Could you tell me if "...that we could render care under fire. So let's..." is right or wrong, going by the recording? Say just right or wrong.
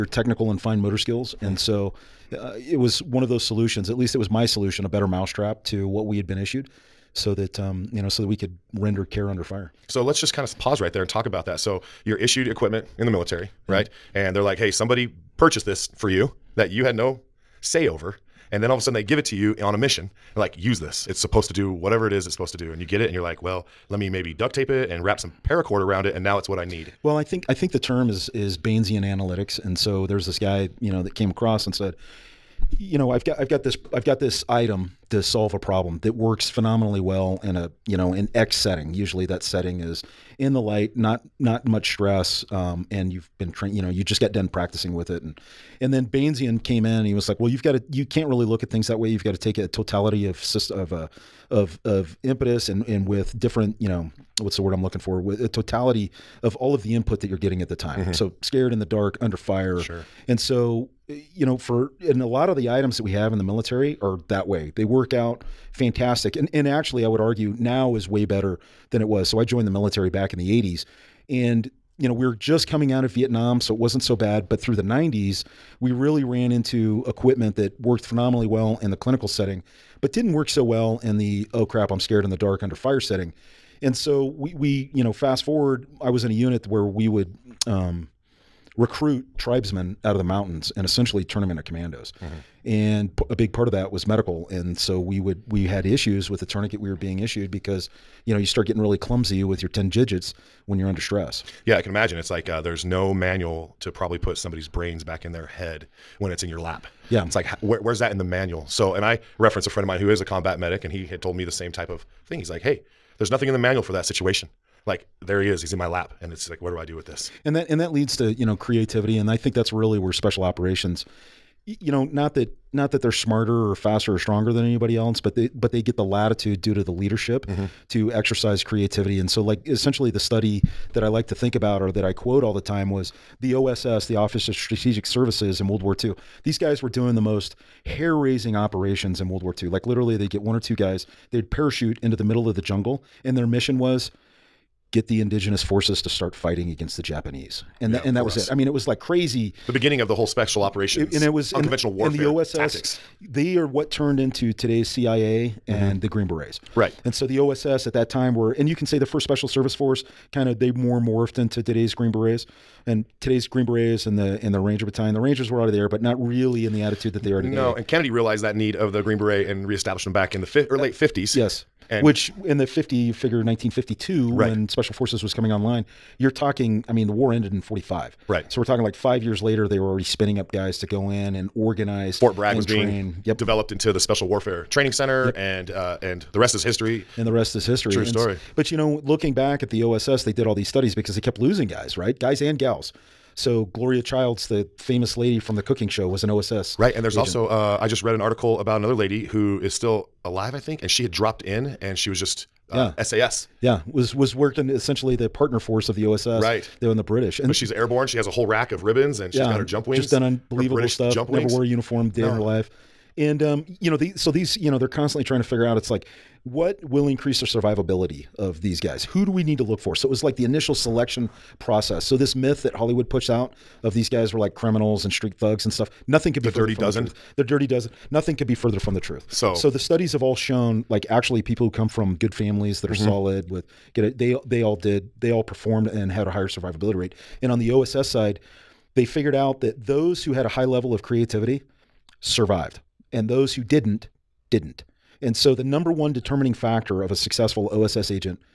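right.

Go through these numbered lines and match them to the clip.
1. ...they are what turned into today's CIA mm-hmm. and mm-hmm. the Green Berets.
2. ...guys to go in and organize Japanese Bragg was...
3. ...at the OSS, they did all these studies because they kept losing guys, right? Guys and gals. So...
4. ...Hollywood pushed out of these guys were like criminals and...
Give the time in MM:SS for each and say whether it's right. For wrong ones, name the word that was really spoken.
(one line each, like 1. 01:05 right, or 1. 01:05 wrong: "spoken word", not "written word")
1. 02:33 right
2. 03:00 wrong: "Fort", not "Japanese"
3. 03:09 right
4. 03:42 right.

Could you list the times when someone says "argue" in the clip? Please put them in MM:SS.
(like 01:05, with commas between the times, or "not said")
01:07.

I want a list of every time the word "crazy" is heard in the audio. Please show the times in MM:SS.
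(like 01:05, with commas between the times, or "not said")
02:28.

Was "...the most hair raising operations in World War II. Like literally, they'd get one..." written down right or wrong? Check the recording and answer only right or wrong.
right.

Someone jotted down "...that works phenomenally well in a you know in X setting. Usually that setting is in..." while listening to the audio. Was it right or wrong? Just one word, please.
right.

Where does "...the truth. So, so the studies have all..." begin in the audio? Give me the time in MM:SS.
03:48.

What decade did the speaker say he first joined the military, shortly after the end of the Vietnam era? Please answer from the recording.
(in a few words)
1980s.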